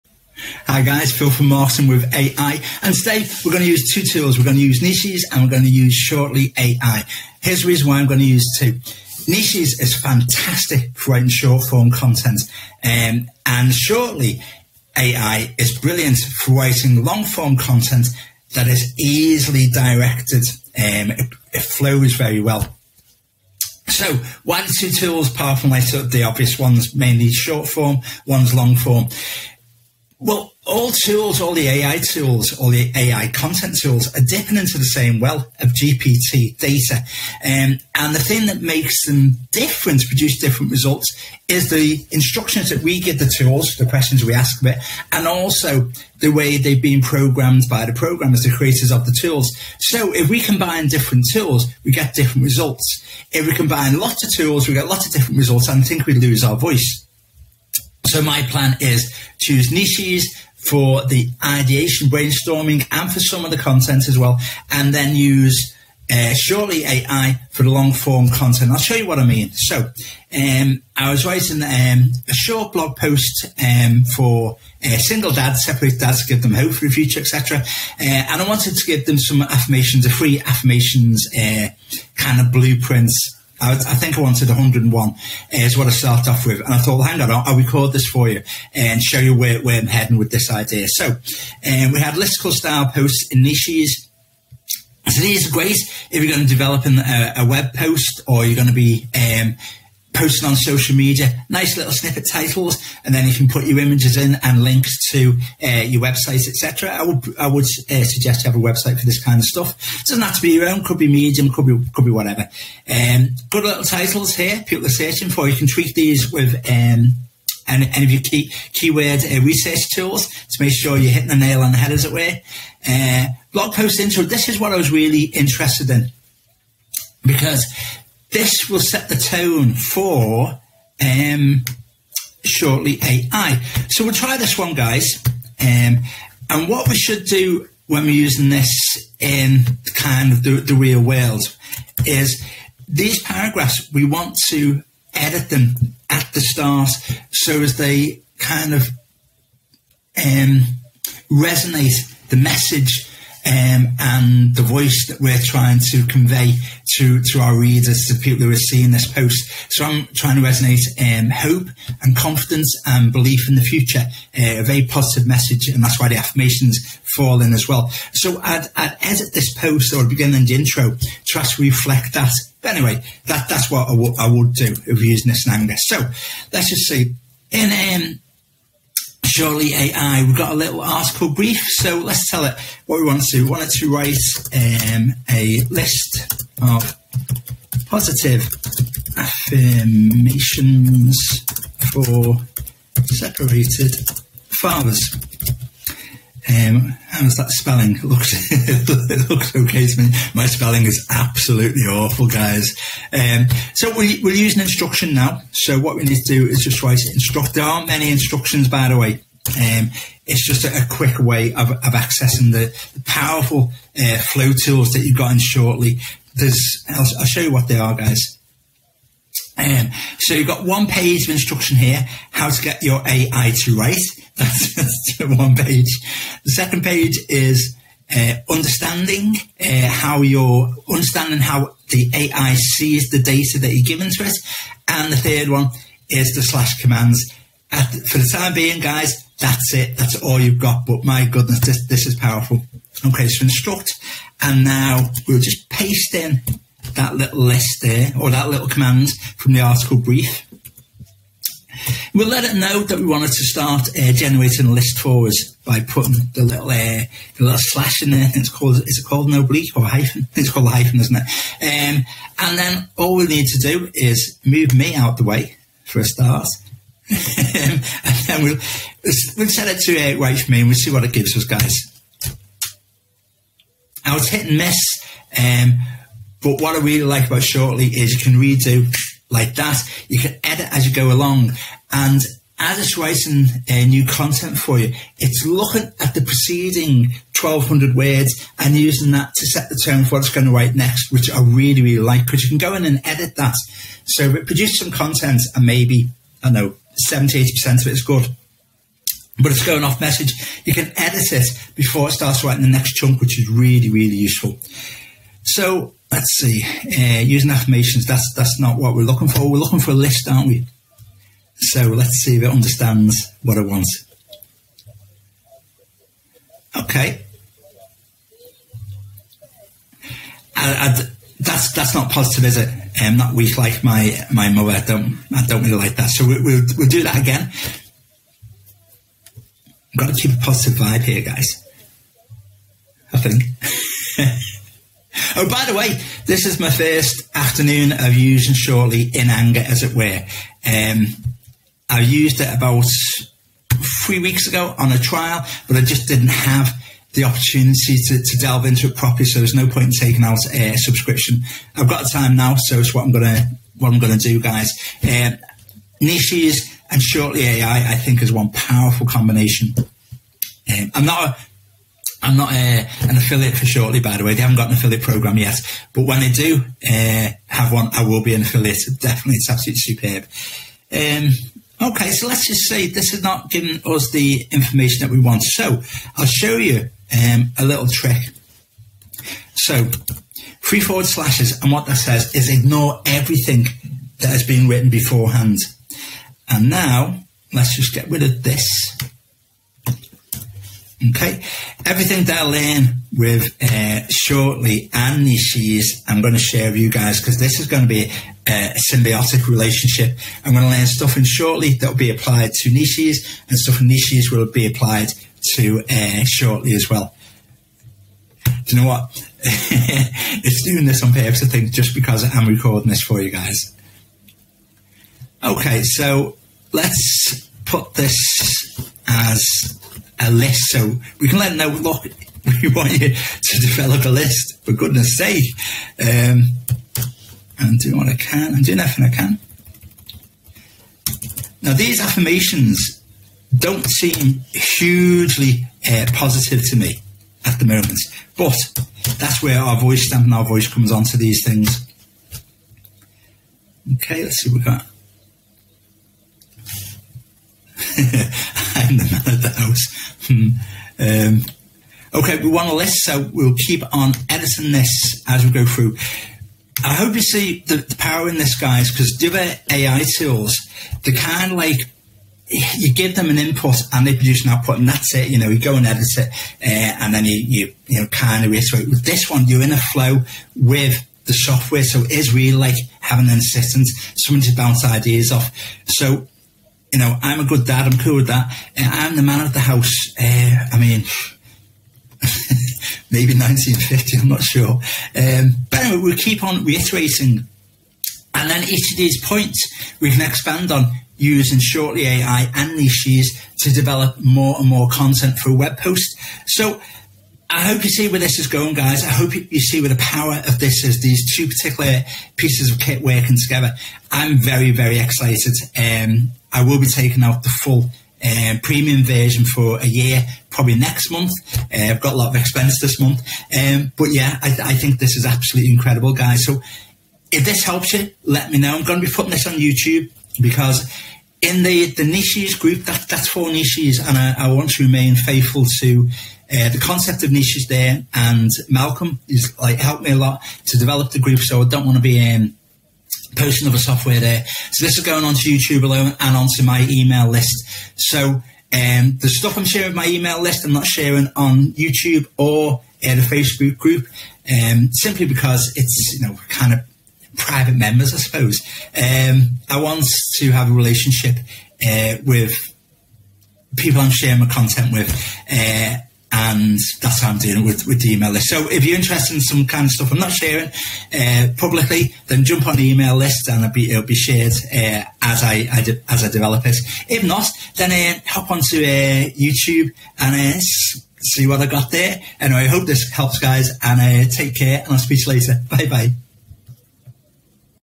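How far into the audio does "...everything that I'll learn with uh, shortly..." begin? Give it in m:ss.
6:31.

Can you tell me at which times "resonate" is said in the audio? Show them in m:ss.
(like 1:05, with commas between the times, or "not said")
2:31, 2:40.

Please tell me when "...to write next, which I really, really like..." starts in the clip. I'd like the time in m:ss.
4:50.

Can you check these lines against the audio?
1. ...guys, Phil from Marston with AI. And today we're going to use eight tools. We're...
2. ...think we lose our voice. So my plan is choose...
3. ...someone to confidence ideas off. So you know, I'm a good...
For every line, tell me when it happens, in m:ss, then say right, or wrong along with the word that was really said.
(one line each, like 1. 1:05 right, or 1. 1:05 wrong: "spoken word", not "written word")
1. 0:00 wrong: "two", not "eight"
2. 0:55 right
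3. 7:54 wrong: "bounce", not "confidence".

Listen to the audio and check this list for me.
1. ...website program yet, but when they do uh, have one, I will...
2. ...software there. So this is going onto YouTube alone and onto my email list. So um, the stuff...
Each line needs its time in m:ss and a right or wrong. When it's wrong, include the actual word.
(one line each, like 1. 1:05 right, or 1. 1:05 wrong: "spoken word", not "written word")
1. 6:04 wrong: "affiliate", not "website"
2. 8:53 right.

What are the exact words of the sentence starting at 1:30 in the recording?
So um, we had listicle style posts in Nichesss.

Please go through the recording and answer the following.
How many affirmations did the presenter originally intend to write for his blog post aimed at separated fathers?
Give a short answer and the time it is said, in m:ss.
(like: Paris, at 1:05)
101, at 1:24.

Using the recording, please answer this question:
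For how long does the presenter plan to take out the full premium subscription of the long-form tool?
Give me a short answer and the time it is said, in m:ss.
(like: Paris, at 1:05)
A year, at 8:29.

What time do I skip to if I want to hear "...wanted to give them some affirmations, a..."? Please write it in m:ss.
1:18.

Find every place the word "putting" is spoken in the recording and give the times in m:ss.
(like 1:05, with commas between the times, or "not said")
4:15, 8:39.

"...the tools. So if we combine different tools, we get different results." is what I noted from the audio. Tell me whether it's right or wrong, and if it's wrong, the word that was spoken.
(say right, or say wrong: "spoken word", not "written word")
right.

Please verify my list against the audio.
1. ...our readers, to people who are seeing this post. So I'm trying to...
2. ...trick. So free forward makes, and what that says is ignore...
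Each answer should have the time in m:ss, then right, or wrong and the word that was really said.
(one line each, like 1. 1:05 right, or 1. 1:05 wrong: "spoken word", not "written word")
1. 2:37 right
2. 6:17 wrong: "slashes", not "makes".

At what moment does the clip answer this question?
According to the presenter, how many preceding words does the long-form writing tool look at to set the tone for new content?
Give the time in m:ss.
4:47.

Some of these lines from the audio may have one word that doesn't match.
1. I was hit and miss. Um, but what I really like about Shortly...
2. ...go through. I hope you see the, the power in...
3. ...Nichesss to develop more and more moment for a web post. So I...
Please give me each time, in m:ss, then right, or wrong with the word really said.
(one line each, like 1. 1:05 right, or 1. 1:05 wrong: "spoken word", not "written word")
1. 4:34 right
2. 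7:35 right
3. 8:12 wrong: "content", not "moment".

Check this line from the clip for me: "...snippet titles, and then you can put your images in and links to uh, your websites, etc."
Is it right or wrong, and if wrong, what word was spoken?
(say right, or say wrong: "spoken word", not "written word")
right.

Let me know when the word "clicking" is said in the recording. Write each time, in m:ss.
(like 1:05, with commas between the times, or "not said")
not said.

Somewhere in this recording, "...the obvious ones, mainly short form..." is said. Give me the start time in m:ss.
0:25.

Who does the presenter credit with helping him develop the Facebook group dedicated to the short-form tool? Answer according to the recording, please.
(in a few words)
Malcolm.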